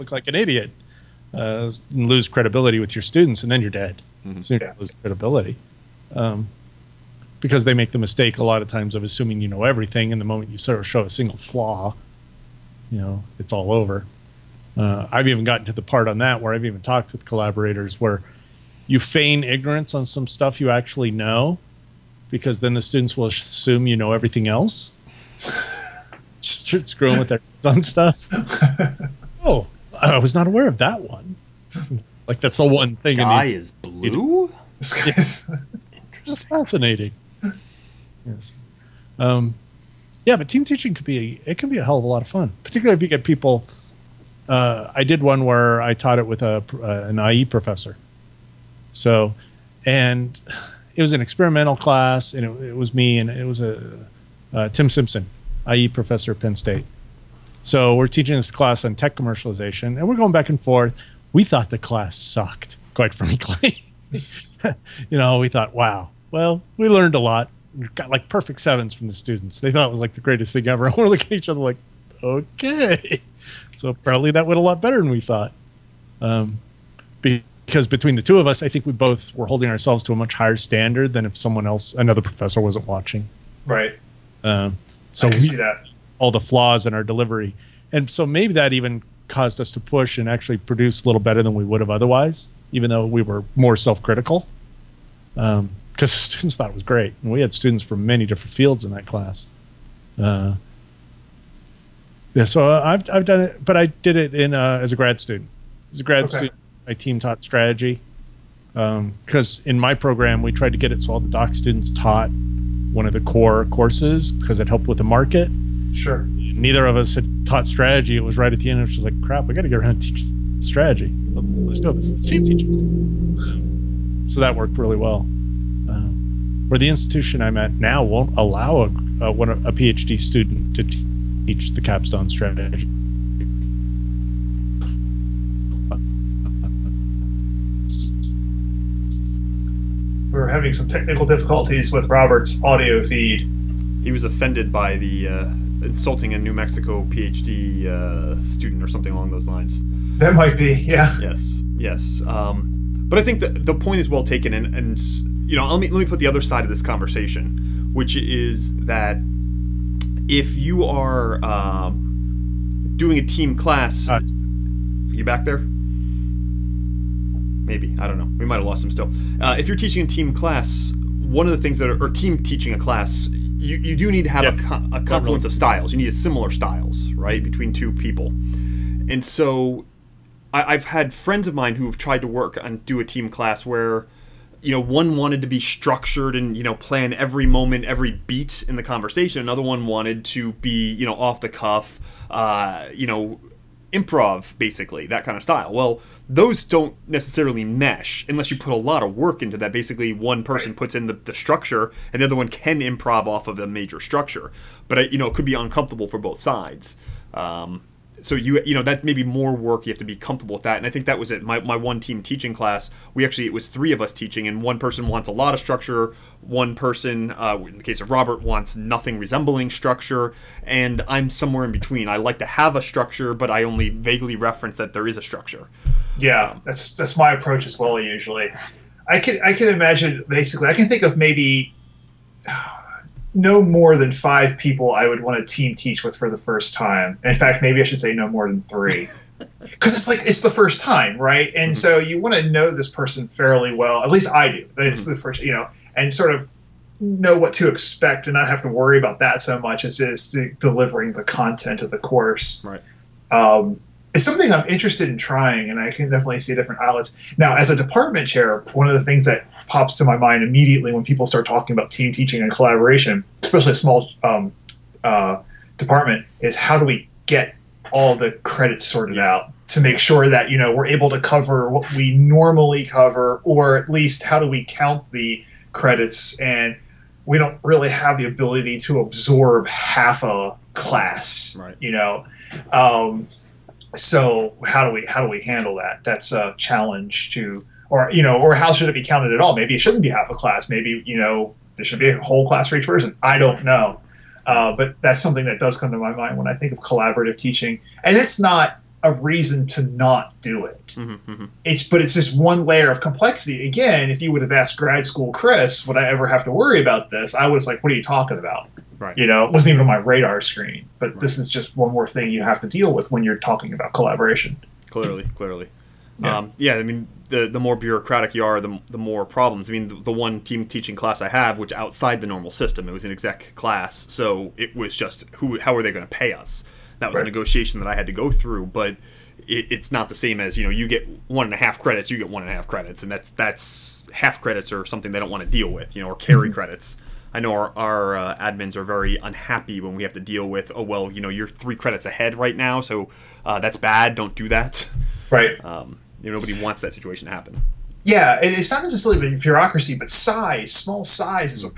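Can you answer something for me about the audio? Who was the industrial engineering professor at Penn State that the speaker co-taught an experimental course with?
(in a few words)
Tim Simpson.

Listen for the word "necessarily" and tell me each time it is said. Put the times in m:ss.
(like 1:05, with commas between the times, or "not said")
3:17, 5:48.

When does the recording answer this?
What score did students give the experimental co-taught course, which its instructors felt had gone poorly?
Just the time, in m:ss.
1:08.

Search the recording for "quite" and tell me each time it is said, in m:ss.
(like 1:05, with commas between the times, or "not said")
1:02.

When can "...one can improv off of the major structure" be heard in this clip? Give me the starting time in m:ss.
3:22.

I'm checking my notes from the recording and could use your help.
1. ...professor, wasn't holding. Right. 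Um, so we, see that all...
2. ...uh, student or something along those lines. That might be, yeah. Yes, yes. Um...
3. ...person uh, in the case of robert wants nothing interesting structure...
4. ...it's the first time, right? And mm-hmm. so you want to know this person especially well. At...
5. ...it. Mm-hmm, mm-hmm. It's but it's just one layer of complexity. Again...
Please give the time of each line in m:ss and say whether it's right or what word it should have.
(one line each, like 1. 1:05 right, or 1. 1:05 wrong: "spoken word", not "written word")
1. 1:22 wrong: "watching", not "holding"
2. 2:27 right
3. 3:36 wrong: "resembling", not "interesting"
4. 4:00 wrong: "fairly", not "especially"
5. 5:00 right.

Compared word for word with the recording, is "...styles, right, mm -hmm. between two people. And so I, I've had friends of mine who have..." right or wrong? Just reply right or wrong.
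right.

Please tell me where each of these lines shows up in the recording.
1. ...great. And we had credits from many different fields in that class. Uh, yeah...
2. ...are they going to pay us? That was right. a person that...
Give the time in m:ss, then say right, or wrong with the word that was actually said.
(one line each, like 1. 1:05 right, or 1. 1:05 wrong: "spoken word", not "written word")
1. 1:36 wrong: "students", not "credits"
2. 5:25 wrong: "negotiation", not "person".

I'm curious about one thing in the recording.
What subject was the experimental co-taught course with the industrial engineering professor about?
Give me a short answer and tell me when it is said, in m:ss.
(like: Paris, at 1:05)
Tech commercialization, at 0:58.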